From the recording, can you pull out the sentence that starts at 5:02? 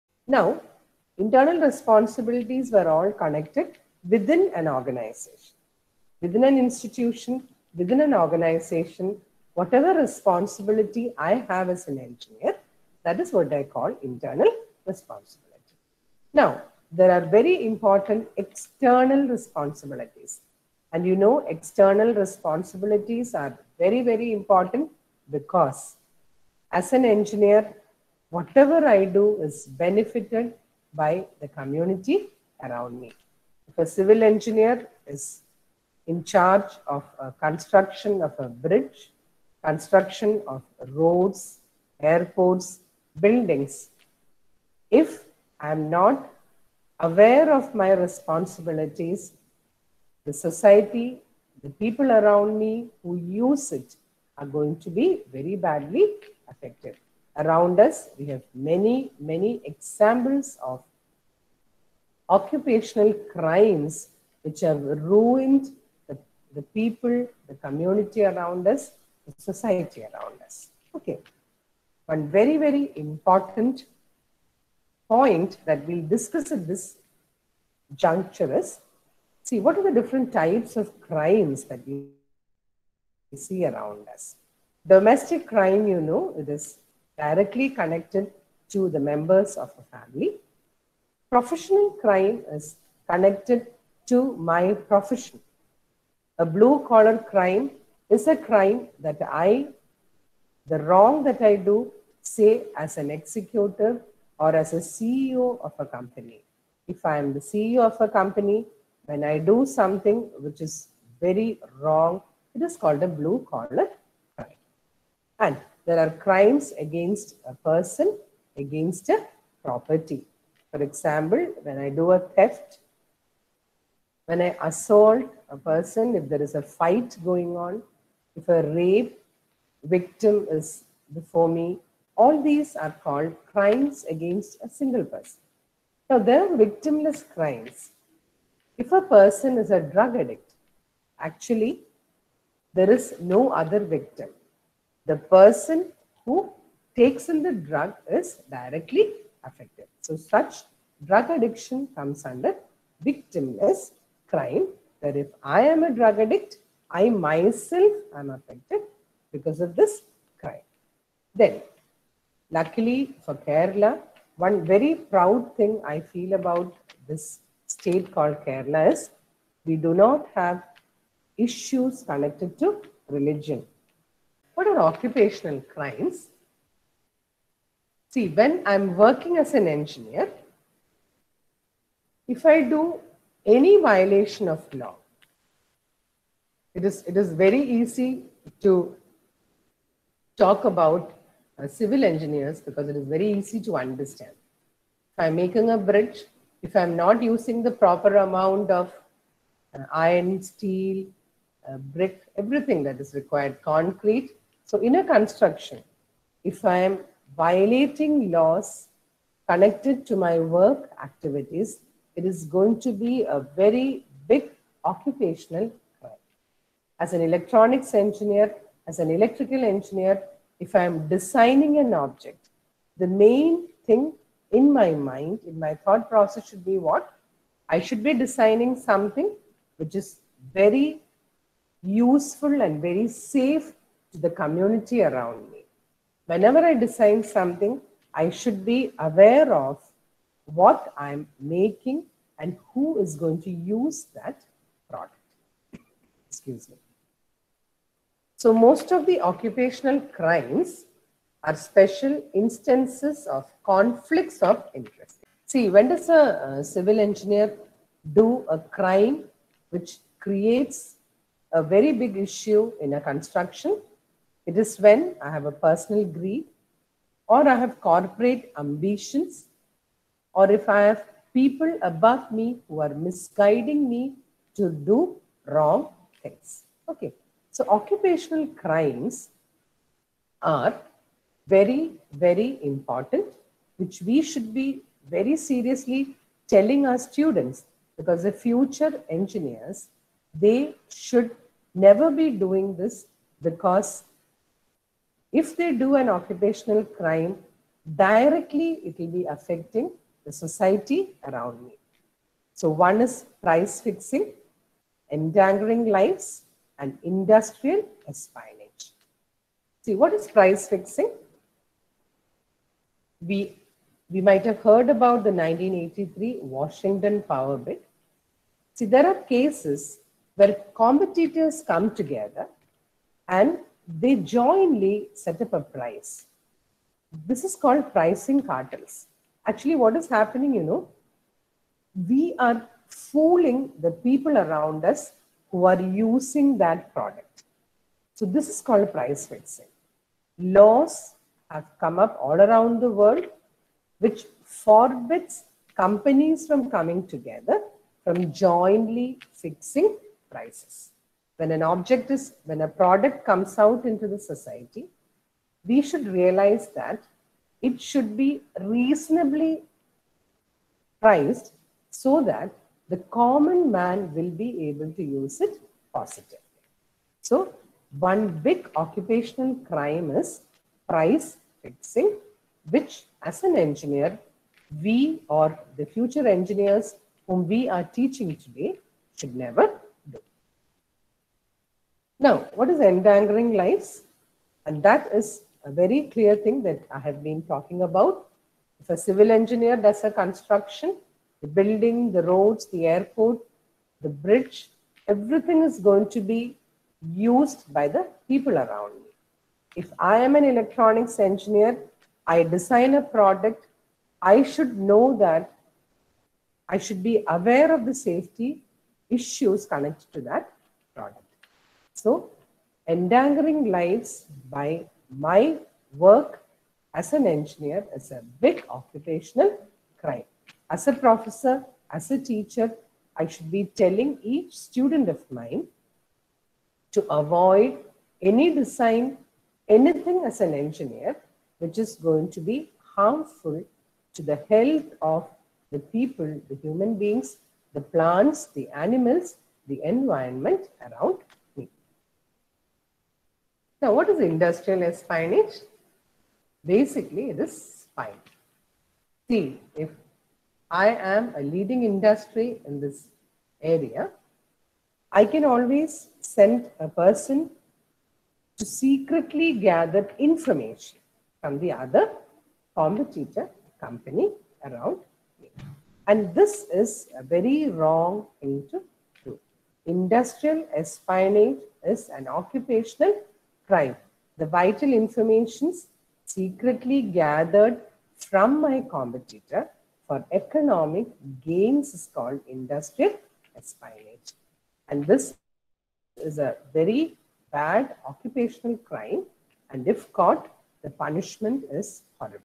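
So one is price fixing, endangering lives, and industrial espionage.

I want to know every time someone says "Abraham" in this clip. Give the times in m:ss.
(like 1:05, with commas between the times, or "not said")
not said.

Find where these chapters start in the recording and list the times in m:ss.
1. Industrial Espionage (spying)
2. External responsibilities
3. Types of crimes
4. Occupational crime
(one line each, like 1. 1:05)
1. 7:24
2. 0:19
3. 1:20
4. 2:54.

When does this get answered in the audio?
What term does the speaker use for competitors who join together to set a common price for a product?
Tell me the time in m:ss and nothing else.
5:27.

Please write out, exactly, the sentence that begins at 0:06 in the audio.
Within an institution, within an organization, whatever responsibility I have as an engineer, that is what I call internal responsibility.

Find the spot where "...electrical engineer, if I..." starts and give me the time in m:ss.
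3:39.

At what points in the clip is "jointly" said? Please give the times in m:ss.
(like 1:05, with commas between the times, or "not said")
5:24, 5:48.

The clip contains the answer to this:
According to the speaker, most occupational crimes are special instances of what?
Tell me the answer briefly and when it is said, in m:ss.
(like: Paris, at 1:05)
Conflicts of interest, at 4:13.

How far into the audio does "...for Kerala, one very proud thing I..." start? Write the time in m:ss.
2:43.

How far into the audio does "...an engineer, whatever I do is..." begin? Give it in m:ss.
0:26.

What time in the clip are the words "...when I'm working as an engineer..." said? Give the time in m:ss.
2:58.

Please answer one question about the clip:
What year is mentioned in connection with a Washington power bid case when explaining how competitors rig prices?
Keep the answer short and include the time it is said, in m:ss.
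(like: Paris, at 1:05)
1983, at 5:15.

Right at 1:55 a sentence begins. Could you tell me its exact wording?
And there are crimes against a person, against a property.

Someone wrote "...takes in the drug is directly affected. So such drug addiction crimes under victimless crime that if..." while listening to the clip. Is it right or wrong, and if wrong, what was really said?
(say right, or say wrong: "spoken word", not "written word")
wrong: "comes", not "crimes".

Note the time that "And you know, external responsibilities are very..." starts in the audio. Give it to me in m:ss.
0:20.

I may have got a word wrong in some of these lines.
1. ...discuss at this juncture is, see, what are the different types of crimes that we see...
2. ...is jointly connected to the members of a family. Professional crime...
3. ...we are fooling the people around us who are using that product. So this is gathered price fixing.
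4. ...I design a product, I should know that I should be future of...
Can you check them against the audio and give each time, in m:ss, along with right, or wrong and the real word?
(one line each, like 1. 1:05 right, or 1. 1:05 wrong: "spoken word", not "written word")
1. 1:16 right
2. 1:26 wrong: "directly", not "jointly"
3. 5:32 wrong: "called", not "gathered"
4. 6:42 wrong: "aware", not "future".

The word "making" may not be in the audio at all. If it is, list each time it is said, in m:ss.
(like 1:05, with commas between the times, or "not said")
3:15, 4:01.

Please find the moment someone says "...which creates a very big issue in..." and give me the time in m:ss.
4:19.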